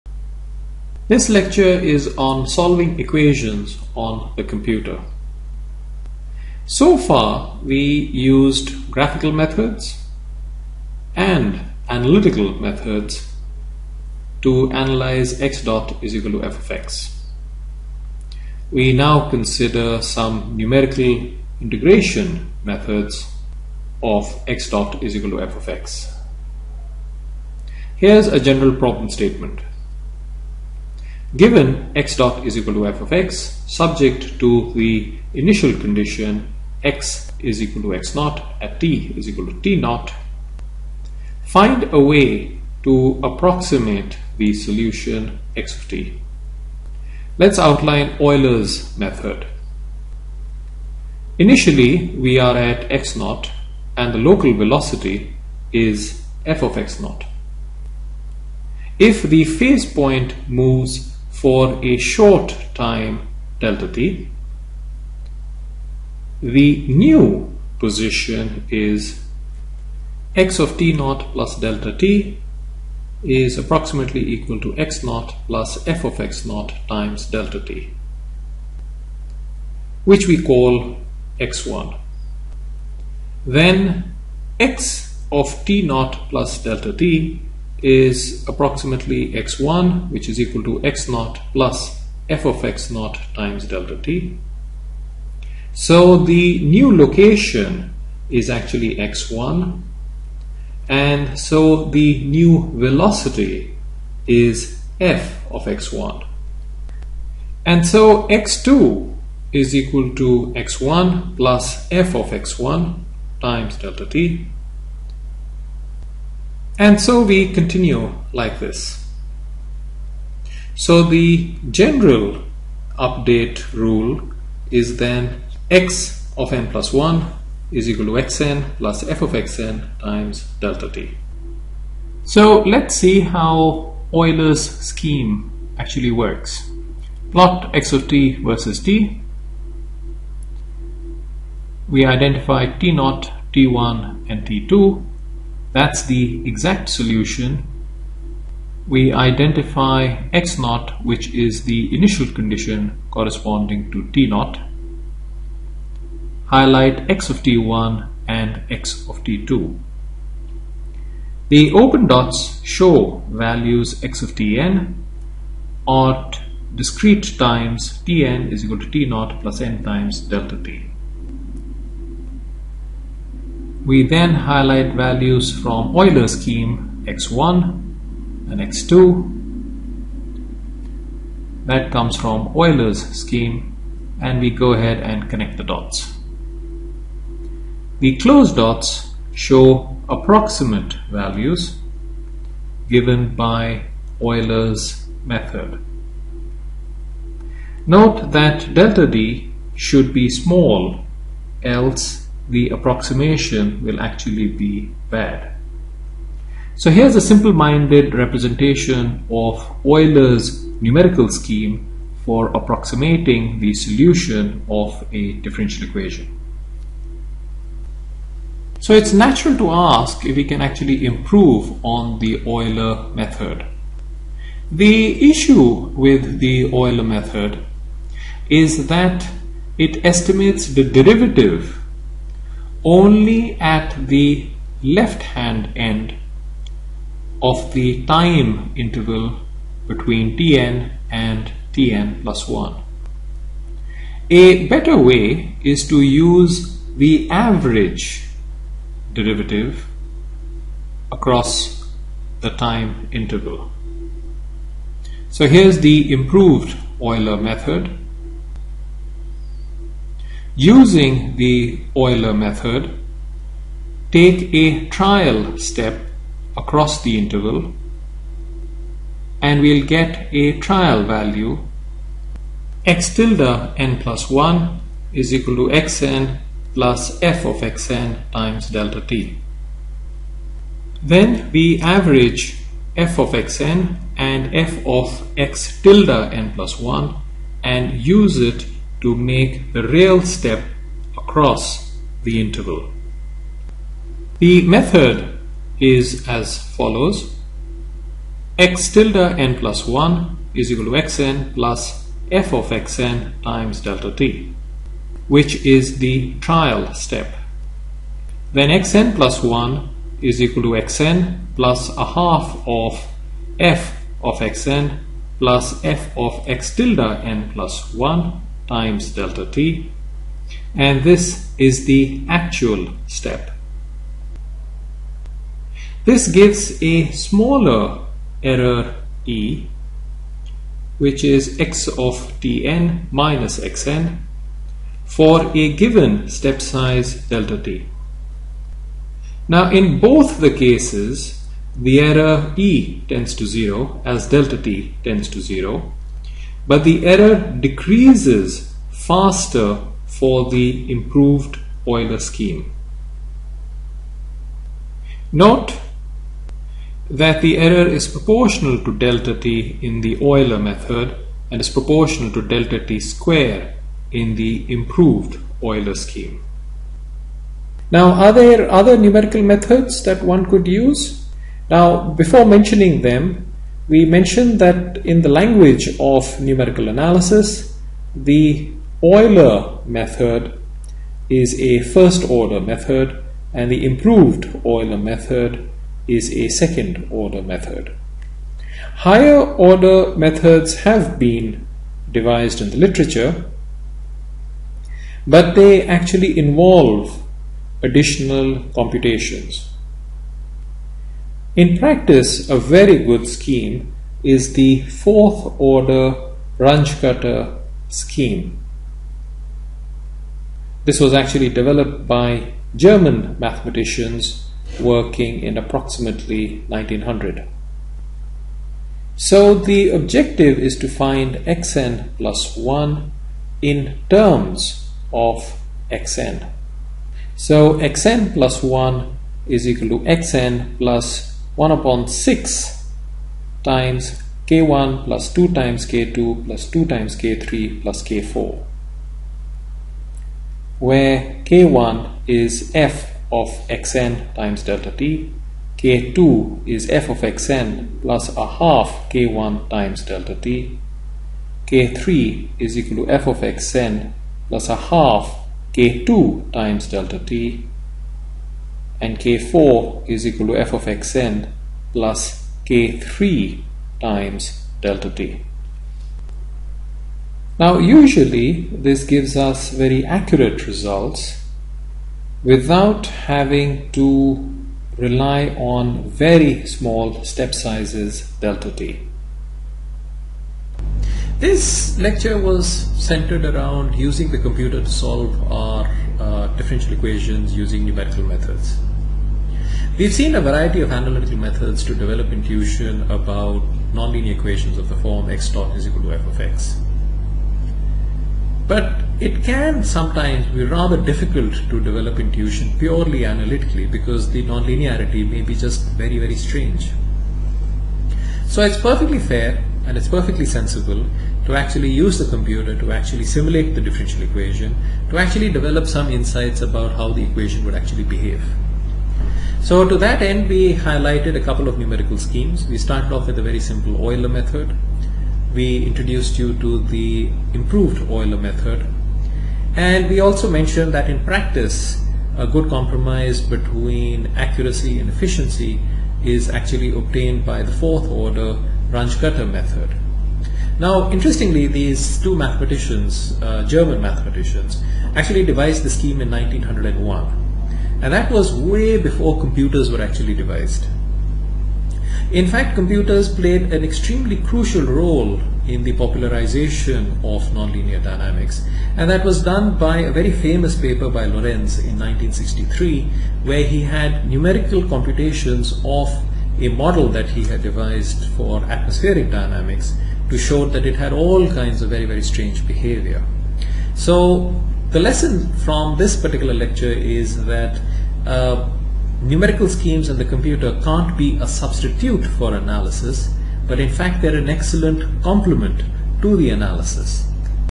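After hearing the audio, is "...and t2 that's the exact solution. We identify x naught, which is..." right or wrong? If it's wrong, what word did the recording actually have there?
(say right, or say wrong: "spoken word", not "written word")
right.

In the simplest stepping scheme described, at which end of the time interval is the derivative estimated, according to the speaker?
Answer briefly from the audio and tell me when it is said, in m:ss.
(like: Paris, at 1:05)
left hand end, at 3:54.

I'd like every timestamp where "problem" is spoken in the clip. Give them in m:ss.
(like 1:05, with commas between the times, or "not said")
0:28.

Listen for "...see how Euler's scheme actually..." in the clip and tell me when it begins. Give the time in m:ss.
2:12.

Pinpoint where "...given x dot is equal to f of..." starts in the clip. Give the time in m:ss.
0:31.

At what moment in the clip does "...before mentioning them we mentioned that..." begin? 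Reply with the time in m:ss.
6:12.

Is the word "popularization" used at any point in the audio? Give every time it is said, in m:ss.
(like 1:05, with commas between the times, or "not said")
9:15.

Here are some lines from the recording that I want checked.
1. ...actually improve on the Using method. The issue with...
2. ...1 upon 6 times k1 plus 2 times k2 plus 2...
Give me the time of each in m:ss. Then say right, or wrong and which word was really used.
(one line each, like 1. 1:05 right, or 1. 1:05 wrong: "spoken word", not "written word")
1. 3:40 wrong: "Euler", not "Using"
2. 7:11 right.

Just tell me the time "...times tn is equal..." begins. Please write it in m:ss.
2:47.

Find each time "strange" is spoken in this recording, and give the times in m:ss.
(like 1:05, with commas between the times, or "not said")
8:26, 9:32.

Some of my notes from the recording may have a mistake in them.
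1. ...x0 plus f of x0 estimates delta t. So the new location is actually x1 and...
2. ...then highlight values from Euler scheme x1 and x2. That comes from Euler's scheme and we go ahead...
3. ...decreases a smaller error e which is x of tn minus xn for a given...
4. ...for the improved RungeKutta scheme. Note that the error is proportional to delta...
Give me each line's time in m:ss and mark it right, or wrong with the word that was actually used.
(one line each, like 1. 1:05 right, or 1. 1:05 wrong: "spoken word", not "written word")
1. 1:30 wrong: "times", not "estimates"
2. 2:54 right
3. 5:26 wrong: "gives", not "decreases"
4. 5:50 wrong: "Euler", not "RungeKutta".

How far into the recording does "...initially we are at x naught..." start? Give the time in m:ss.
0:51.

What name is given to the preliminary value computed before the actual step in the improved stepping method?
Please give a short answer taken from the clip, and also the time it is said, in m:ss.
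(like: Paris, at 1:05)
trial value, at 4:30.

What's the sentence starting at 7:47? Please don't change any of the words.
Now usually this gives us very accurate results without having to rely on very small step sizes delta t.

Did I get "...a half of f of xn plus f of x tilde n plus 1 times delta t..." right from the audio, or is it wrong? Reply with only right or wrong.
right.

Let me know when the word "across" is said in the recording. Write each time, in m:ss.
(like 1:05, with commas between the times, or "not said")
4:11, 4:26, 4:51.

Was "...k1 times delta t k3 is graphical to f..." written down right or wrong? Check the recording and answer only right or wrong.
wrong.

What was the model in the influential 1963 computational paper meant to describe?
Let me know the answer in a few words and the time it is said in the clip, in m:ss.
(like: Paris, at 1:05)
atmospheric dynamics, at 9:28.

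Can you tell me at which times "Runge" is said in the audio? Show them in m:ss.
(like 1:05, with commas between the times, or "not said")
6:46, 8:58.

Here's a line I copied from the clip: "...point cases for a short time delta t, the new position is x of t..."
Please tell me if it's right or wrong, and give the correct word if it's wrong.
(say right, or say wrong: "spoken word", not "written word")
wrong: "moves", not "cases".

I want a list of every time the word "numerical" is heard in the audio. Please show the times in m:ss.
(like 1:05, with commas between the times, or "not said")
0:20, 3:30, 6:08, 6:16, 8:07, 8:41, 9:24, 9:39.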